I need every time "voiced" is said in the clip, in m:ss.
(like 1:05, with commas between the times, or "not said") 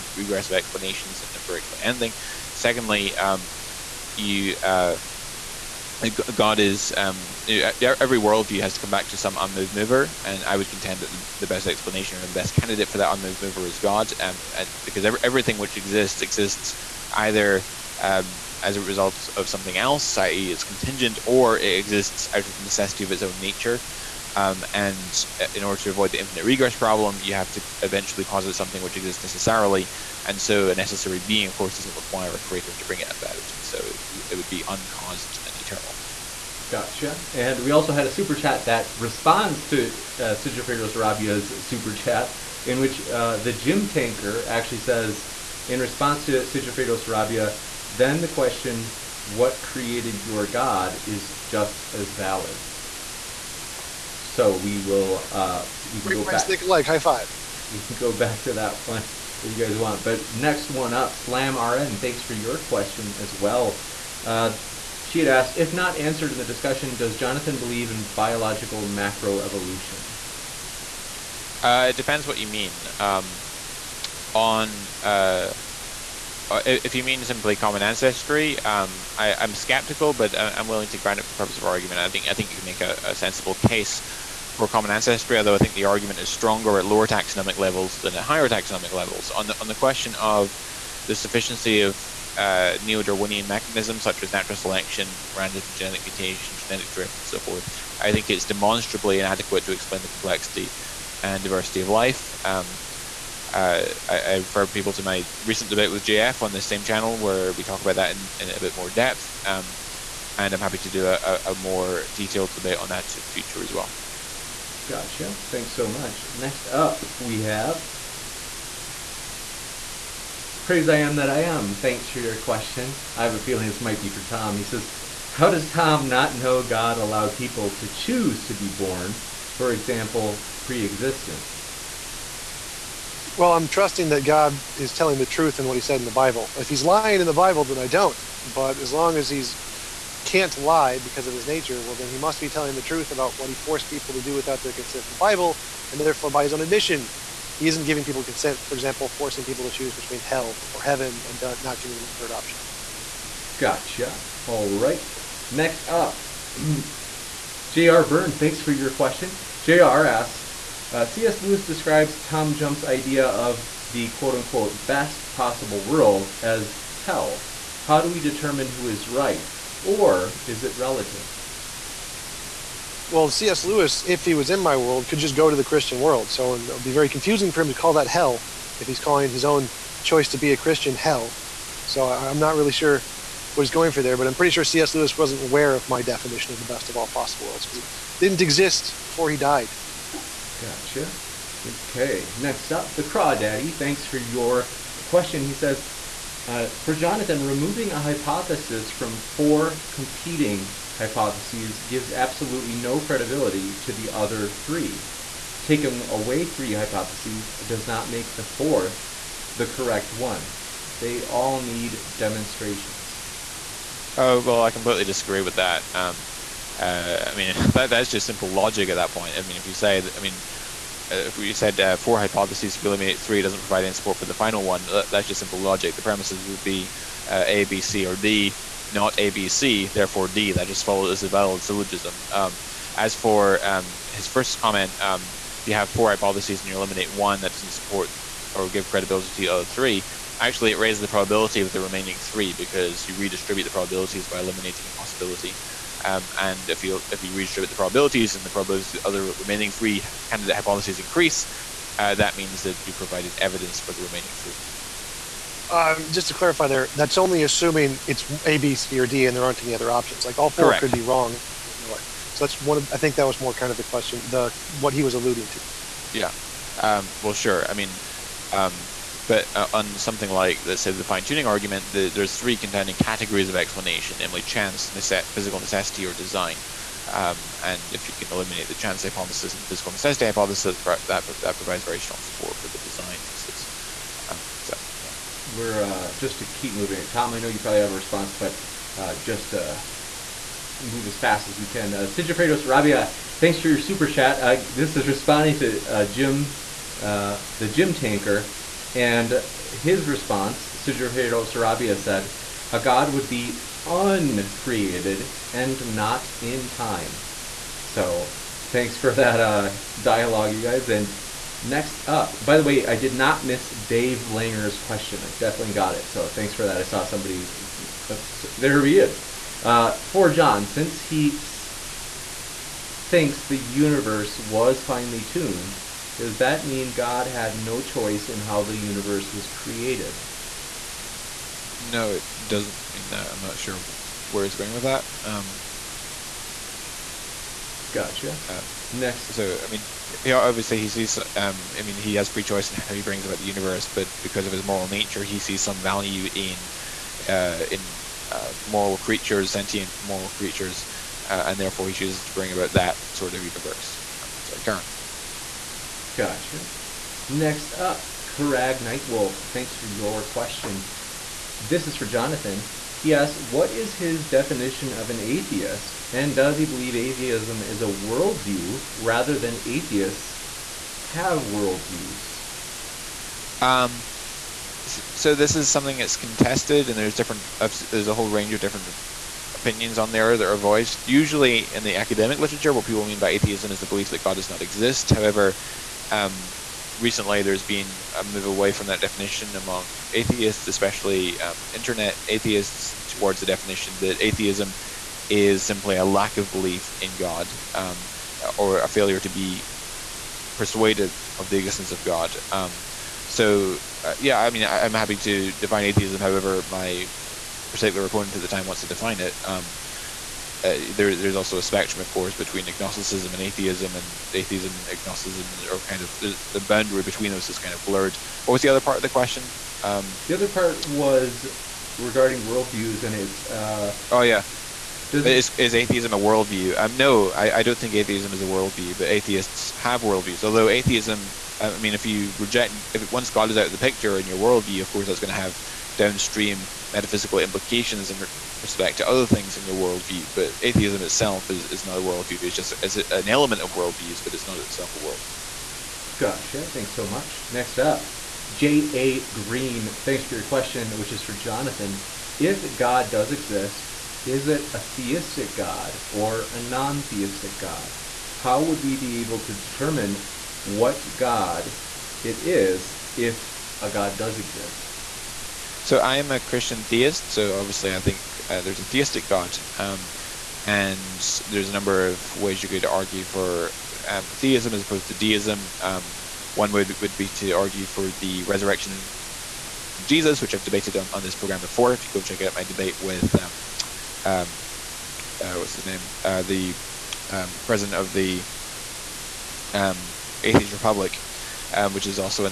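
6:20.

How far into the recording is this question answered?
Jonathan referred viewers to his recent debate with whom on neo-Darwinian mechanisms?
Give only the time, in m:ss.
1:46.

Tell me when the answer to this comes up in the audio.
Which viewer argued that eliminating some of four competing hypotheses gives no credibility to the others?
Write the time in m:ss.
3:12.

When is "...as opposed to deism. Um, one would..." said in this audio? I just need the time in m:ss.
7:54.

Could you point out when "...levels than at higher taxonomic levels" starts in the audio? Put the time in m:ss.
1:27.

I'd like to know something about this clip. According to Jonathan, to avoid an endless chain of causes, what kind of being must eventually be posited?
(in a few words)
necessary being.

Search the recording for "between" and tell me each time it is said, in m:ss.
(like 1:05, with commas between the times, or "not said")
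2:29, 6:52, 6:57.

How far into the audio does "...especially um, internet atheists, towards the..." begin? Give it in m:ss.
6:30.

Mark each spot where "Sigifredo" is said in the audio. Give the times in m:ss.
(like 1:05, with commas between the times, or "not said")
0:40, 0:46, 4:51, 5:00.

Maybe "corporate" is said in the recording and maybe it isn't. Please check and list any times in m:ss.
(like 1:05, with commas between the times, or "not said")
not said.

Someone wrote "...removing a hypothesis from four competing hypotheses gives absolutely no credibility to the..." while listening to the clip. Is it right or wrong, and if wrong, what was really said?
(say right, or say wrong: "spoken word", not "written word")
right.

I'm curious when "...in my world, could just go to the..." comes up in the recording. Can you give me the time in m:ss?
2:54.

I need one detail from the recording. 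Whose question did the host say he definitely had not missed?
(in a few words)
Dave Langer.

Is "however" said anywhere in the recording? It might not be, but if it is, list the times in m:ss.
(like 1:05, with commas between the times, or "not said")
6:25, 6:46.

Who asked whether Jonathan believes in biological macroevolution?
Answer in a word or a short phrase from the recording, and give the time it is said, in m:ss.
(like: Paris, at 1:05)
Slam RN, at 1:01.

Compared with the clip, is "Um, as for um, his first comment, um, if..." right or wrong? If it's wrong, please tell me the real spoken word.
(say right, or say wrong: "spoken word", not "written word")
right.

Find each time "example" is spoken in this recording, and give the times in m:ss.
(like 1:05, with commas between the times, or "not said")
2:09, 2:28.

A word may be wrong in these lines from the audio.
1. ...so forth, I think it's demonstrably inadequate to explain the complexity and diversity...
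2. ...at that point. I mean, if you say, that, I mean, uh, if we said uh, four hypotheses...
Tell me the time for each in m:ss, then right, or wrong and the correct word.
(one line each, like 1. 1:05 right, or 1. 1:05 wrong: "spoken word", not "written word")
1. 1:37 right
2. 3:38 right.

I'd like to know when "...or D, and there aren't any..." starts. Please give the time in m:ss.
4:18.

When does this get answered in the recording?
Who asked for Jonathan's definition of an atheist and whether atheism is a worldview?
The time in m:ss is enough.
5:58.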